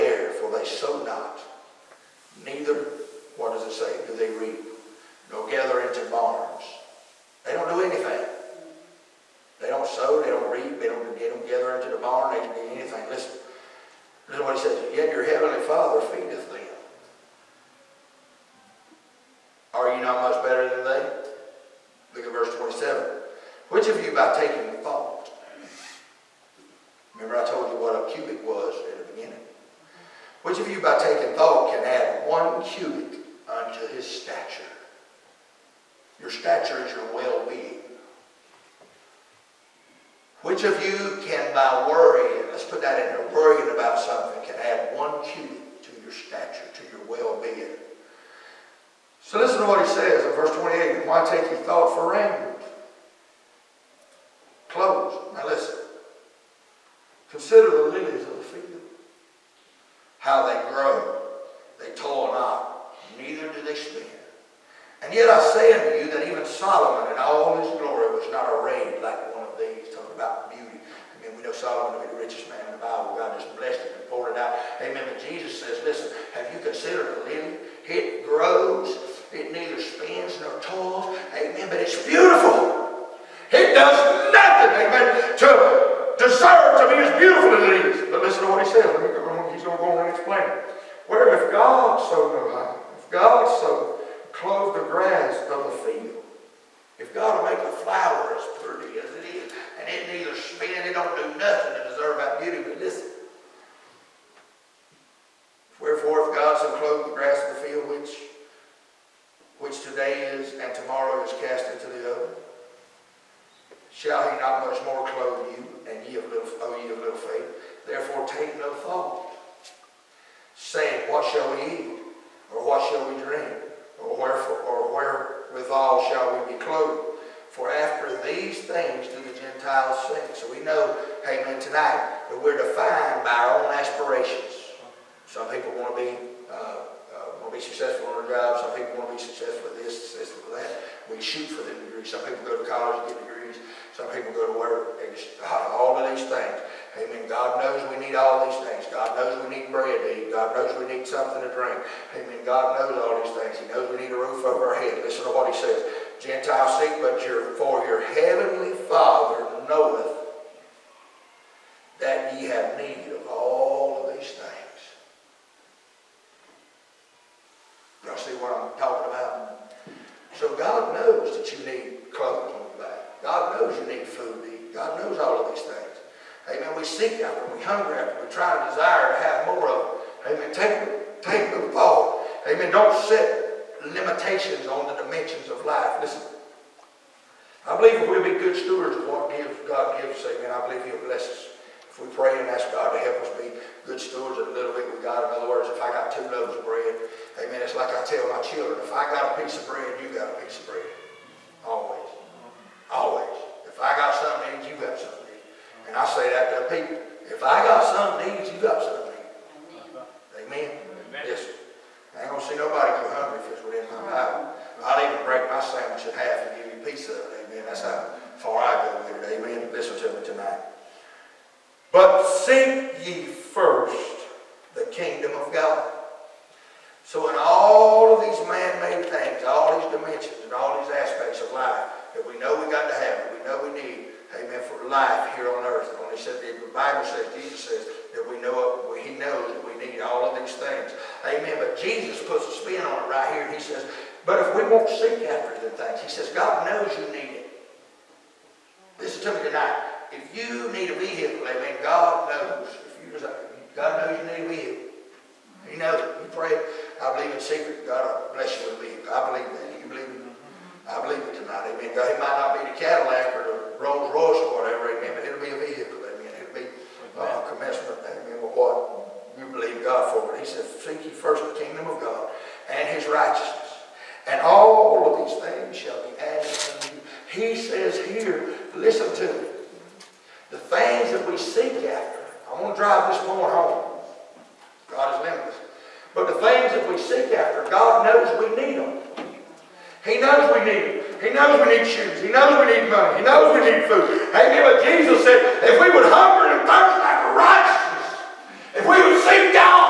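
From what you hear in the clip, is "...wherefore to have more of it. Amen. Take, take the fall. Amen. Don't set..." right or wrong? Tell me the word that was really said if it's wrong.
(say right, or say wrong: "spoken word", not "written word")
wrong: "desire", not "wherefore".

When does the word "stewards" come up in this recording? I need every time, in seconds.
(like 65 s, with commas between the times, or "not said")
188 s, 193 s.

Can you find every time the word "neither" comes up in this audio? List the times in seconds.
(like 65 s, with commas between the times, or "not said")
2 s, 63 s, 79 s, 100 s.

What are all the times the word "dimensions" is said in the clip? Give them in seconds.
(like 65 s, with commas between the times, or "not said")
185 s, 229 s.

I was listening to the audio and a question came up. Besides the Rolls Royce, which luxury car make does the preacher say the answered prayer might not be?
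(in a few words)
Cadillac.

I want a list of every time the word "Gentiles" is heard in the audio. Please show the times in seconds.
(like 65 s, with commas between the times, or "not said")
129 s, 156 s.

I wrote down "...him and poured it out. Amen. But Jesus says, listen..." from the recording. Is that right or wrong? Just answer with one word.
right.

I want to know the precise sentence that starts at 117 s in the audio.
Therefore take no thought, saying, What shall we eat?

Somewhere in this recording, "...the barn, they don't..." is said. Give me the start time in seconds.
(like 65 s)
11 s.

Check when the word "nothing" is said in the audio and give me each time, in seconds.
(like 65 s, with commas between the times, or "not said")
84 s, 101 s.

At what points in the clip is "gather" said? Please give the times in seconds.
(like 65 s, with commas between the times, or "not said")
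5 s, 11 s.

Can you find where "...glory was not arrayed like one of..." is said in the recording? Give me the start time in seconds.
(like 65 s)
67 s.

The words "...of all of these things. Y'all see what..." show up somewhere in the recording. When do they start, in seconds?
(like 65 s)
163 s.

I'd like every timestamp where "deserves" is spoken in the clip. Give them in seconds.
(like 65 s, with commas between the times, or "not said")
86 s, 101 s.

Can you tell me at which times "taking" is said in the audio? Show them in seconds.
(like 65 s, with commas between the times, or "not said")
24 s, 30 s.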